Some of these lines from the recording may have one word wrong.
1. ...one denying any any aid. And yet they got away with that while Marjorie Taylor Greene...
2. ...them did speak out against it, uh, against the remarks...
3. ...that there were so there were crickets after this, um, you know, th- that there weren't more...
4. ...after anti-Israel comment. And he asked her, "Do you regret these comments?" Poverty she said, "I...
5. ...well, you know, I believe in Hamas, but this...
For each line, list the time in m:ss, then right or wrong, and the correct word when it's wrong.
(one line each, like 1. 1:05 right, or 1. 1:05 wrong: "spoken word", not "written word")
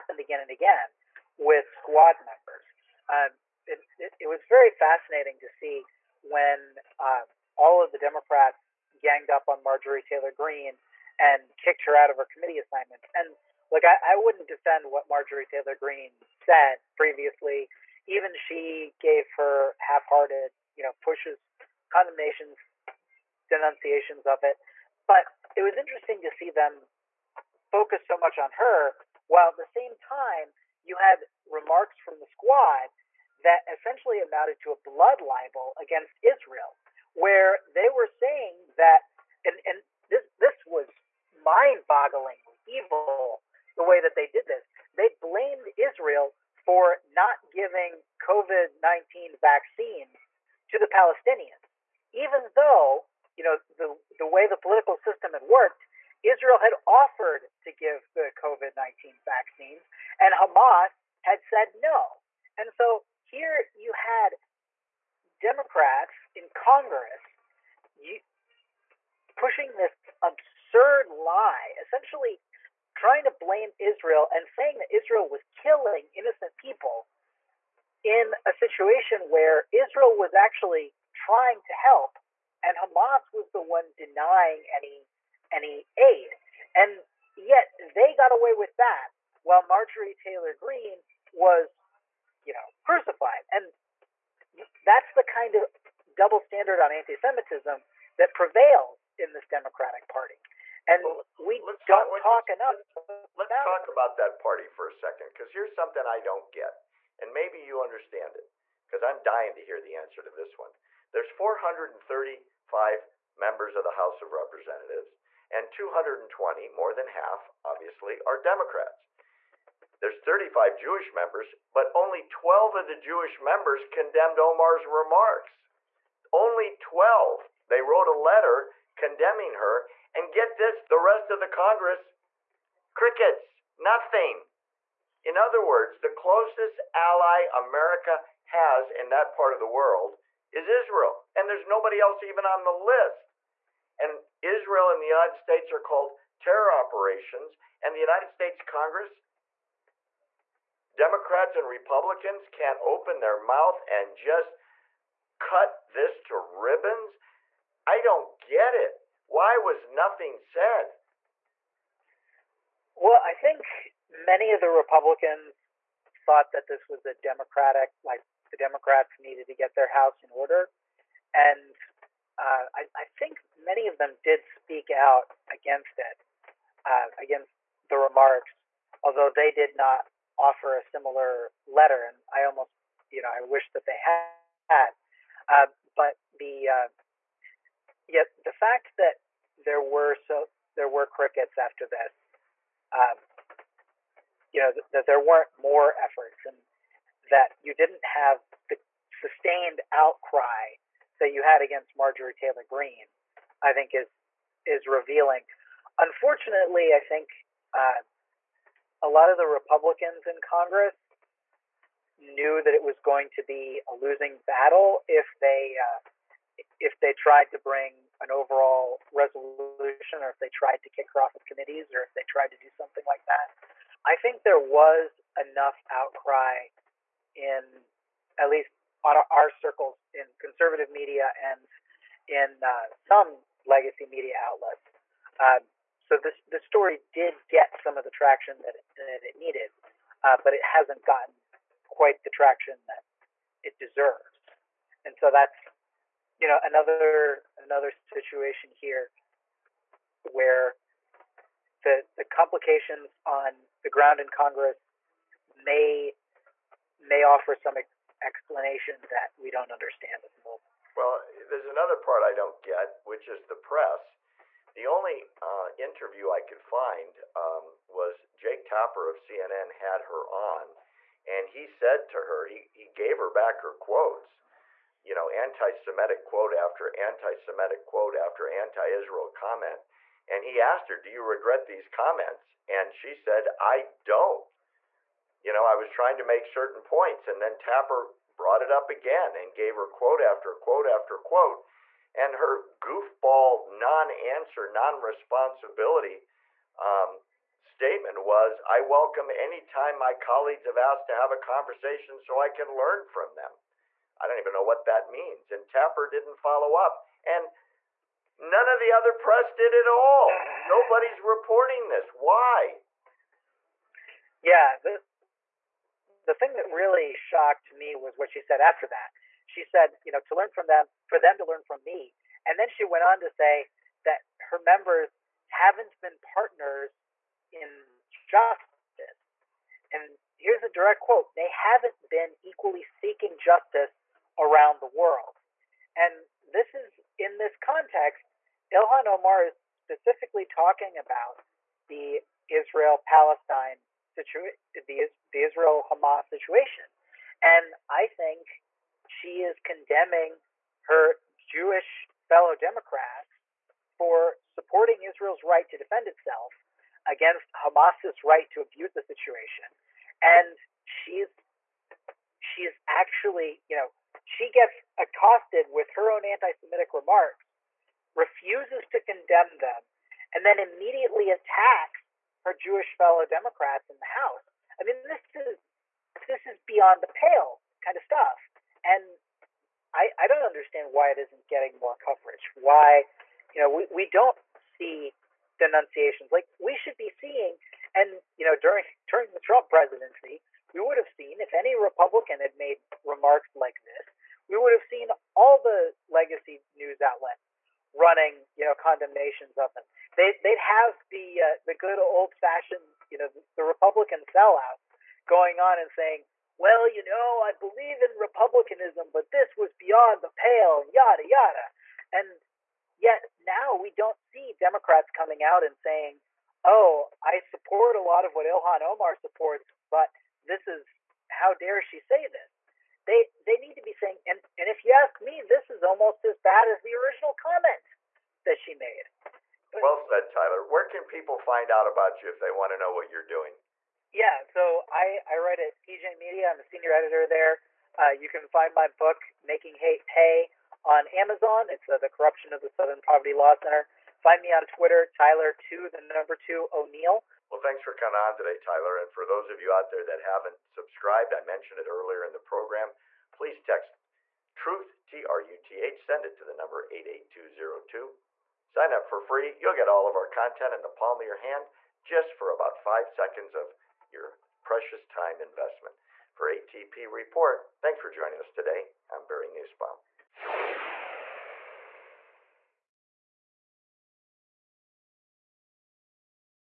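1. 1:23 right
2. 2:53 right
3. 3:08 right
4. 4:38 wrong: "And", not "Poverty"
5. 6:46 wrong: "Republicanism", not "Hamas".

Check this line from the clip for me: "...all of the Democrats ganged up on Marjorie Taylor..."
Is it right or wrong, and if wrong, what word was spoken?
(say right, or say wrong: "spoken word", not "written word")
right.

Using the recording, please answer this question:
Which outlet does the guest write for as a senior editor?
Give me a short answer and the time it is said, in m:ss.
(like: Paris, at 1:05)
PJ Media, at 7:15.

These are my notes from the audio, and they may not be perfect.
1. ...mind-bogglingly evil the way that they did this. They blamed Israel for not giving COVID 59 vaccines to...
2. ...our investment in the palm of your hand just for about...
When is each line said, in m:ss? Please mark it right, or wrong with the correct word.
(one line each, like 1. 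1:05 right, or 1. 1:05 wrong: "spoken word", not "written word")
1. 0:41 wrong: "19", not "59"
2. 7:40 wrong: "content", not "investment".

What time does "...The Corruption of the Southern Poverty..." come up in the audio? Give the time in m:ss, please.
7:21.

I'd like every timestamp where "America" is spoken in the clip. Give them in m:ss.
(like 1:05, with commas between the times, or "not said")
2:17.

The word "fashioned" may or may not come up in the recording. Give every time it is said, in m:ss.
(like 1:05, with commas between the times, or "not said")
6:42.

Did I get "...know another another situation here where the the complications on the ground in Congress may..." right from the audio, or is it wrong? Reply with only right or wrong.
right.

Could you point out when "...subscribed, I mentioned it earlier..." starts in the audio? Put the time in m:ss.
7:30.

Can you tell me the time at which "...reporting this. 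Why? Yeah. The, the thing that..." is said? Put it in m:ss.
5:11.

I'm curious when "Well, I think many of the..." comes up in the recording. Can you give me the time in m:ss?
2:42.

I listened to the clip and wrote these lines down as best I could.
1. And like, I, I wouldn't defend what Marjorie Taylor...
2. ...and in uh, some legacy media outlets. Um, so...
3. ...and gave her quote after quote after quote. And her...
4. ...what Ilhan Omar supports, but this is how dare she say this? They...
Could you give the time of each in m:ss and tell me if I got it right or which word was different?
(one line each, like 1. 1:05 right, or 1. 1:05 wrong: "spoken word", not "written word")
1. 0:13 right
2. 3:51 right
3. 4:49 right
4. 6:58 right.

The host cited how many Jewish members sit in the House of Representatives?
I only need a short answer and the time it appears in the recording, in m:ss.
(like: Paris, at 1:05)
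35, at 2:00.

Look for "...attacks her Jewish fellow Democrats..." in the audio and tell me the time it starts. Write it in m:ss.
6:11.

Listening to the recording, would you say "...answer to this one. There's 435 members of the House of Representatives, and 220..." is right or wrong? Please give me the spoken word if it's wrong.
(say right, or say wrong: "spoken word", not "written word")
right.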